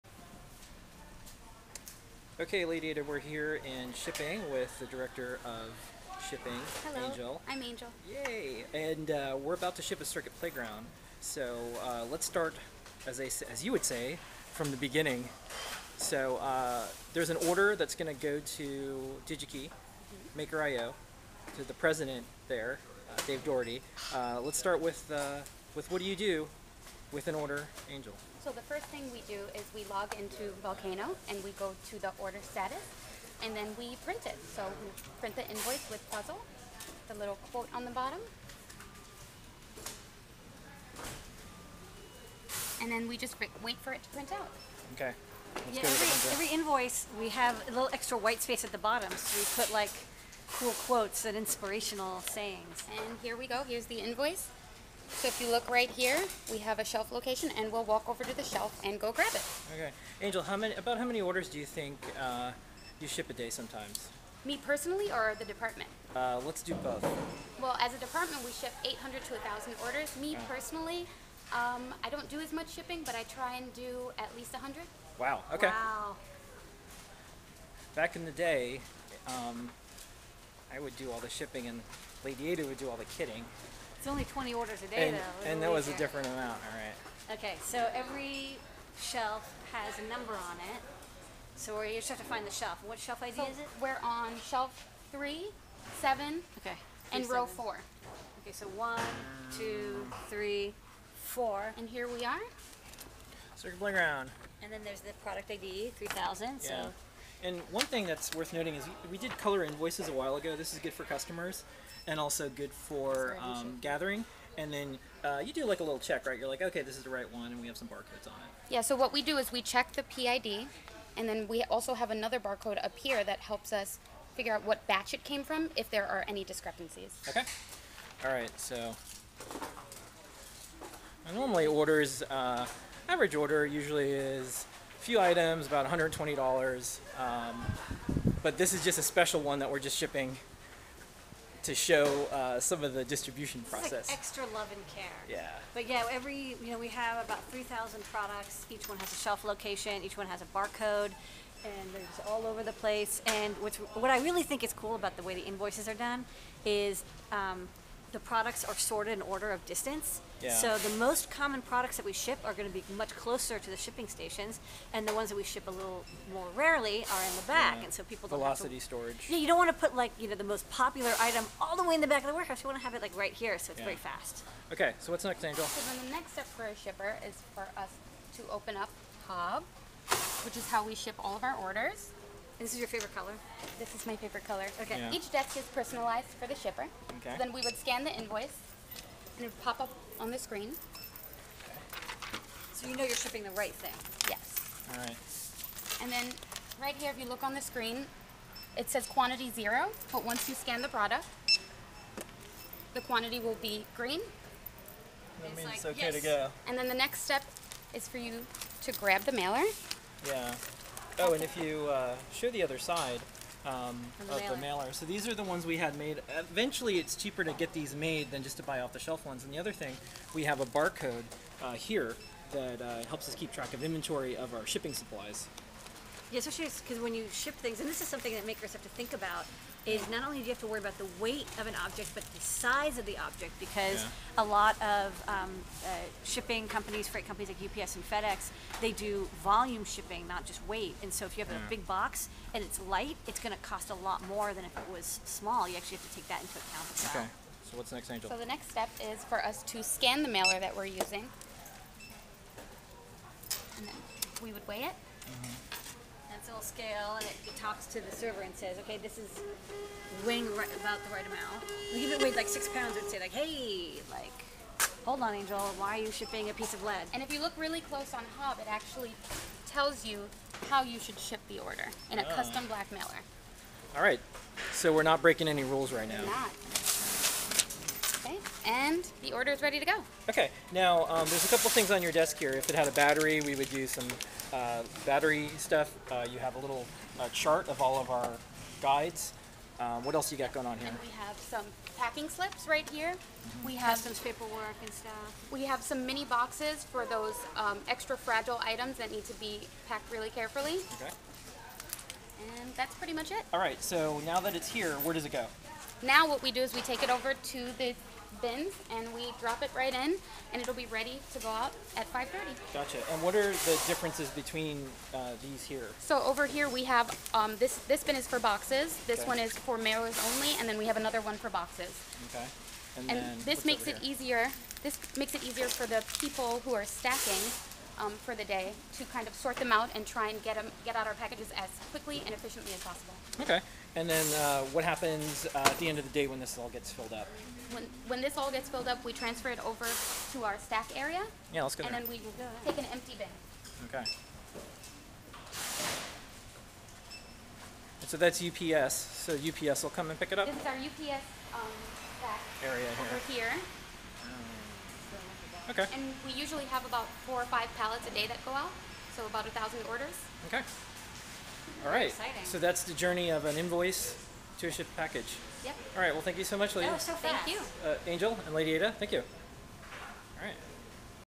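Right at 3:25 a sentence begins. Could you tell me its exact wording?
That means like, it's okay yes.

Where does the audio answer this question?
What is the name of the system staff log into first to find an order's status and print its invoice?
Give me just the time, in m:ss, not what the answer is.
0:30.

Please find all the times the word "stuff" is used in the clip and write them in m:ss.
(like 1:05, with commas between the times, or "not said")
4:45, 4:55.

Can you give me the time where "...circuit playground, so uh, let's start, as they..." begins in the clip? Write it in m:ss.
0:10.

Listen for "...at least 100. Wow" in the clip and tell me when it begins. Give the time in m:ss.
1:14.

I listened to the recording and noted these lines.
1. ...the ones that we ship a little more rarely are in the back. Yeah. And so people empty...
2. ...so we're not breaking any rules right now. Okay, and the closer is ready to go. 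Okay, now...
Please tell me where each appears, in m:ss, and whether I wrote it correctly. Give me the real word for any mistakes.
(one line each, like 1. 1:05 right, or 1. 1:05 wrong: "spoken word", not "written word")
1. 2:45 wrong: "velocity", not "empty"
2. 4:34 wrong: "order", not "closer".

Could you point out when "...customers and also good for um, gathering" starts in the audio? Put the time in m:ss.
1:51.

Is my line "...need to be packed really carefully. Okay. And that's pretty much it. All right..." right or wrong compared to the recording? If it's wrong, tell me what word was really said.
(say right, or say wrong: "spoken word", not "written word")
right.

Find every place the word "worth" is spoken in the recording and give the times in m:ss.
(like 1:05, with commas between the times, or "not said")
1:48.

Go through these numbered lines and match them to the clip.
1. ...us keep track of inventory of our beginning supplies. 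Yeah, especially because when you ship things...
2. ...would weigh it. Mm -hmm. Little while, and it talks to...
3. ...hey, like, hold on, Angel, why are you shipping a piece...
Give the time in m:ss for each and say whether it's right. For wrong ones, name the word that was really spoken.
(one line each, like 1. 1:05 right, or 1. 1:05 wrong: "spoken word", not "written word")
1. 3:43 wrong: "shipping", not "beginning"
2. 4:14 wrong: "scale", not "while"
3. 4:23 right.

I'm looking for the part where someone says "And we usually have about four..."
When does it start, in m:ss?
5:55.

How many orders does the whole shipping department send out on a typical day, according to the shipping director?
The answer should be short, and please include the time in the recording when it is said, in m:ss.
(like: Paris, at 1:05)
800 to 1,000, at 1:08.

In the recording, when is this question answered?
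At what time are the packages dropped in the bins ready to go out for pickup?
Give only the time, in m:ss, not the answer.
5:12.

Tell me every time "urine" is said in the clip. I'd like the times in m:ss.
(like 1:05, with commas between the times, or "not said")
not said.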